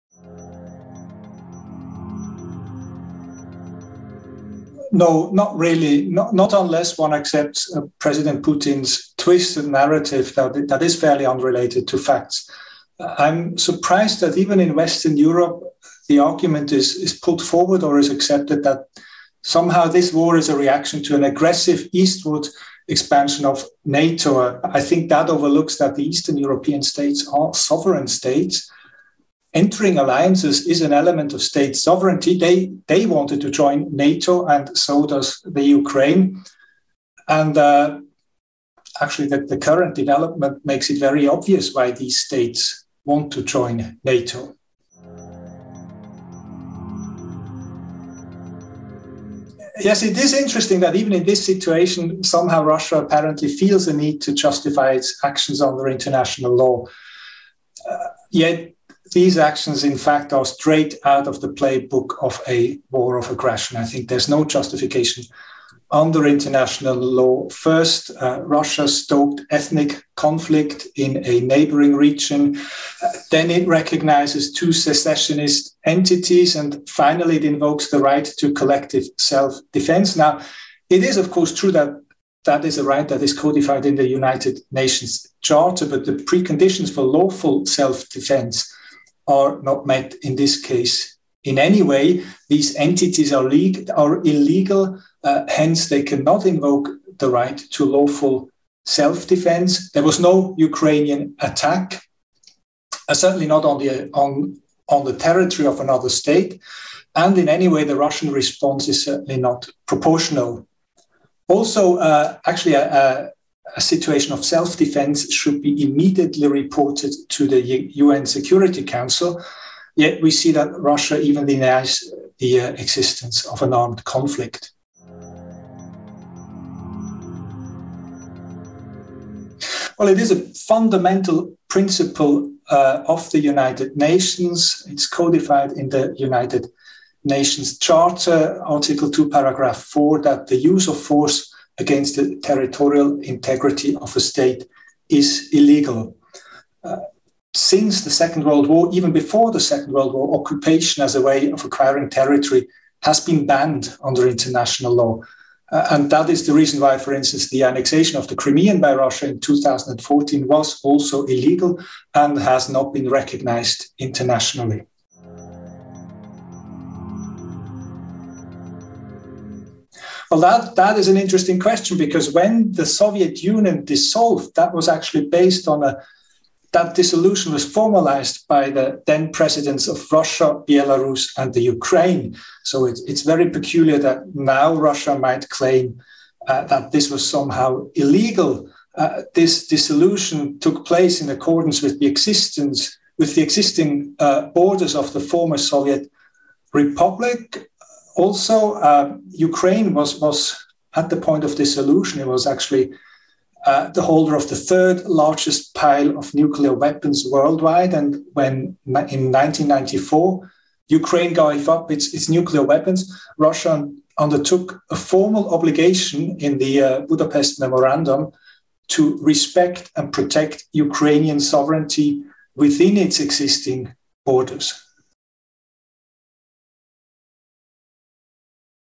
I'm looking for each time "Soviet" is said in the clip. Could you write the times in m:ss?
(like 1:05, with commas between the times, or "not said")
2:52, 3:15.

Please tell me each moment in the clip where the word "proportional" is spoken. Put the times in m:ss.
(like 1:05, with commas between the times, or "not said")
1:49.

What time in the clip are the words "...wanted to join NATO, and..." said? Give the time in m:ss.
0:33.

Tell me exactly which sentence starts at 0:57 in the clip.
Uh, yet these actions, in fact, are straight out of the playbook of a war of aggression.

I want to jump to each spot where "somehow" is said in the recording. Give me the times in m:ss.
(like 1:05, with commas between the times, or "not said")
0:19, 0:52, 3:07.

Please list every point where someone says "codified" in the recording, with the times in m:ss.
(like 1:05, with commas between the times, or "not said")
1:23, 2:15.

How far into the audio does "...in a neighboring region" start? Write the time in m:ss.
1:10.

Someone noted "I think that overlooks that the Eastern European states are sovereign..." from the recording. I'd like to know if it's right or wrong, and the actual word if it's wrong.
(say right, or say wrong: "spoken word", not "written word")
right.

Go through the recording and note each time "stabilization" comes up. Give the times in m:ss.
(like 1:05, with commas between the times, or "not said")
not said.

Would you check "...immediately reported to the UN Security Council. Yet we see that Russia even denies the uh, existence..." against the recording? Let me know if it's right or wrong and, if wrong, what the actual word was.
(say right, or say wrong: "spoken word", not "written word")
right.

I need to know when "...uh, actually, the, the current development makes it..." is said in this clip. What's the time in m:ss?
0:37.